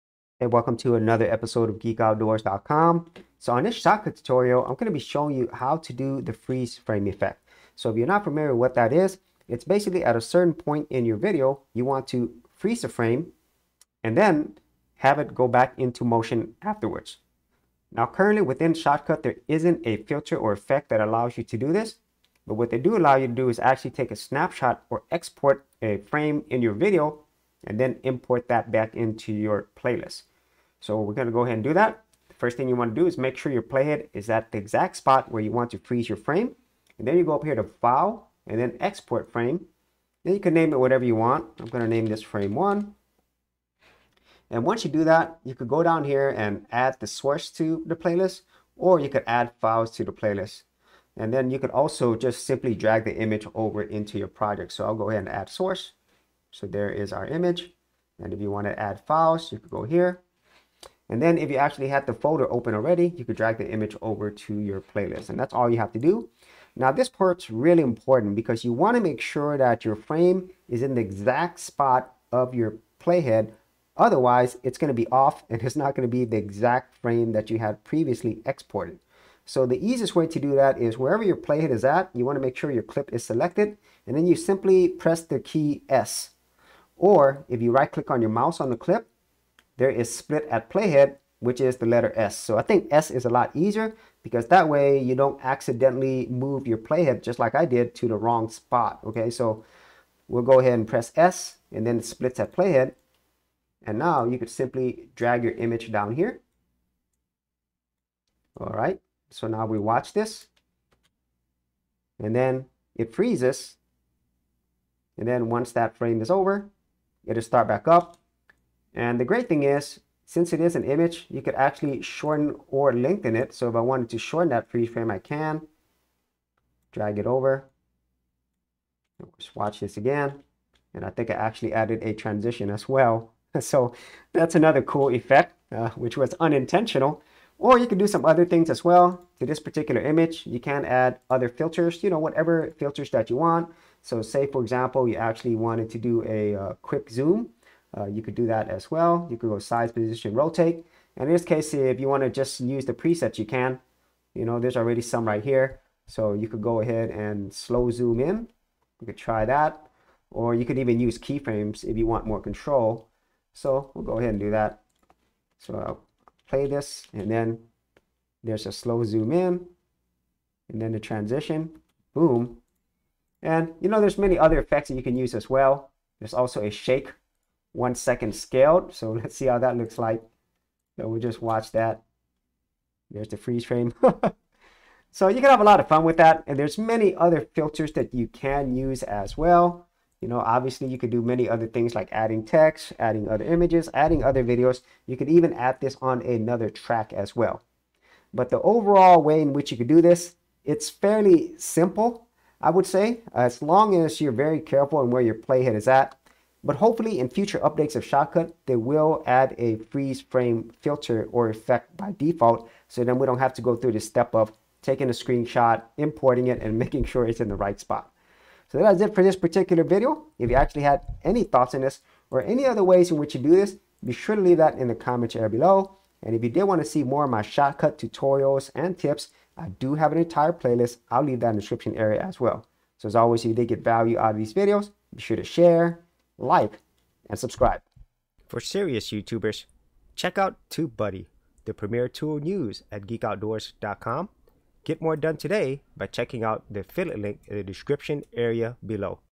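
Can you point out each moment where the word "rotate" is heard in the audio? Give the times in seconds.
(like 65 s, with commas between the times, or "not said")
150 s.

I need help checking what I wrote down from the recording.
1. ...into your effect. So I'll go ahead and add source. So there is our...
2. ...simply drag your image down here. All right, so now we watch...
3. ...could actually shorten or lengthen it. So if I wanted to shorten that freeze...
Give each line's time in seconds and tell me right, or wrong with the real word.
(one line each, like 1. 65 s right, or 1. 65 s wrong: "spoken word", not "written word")
1. 53 s wrong: "project", not "effect"
2. 104 s right
3. 121 s right.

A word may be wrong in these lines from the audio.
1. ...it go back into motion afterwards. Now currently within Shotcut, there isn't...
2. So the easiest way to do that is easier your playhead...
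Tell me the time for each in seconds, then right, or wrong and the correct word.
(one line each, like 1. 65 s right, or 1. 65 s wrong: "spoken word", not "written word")
1. 15 s right
2. 79 s wrong: "wherever", not "easier".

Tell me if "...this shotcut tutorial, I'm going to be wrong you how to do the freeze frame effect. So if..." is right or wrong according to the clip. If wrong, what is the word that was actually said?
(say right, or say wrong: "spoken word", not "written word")
wrong: "showing", not "wrong".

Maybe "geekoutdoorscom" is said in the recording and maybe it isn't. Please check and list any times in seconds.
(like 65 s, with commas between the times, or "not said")
1 s, 243 s.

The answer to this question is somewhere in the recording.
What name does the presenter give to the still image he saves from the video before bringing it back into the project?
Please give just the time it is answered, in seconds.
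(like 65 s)
42 s.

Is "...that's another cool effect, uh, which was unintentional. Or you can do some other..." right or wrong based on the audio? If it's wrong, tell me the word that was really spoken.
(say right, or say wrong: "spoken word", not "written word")
right.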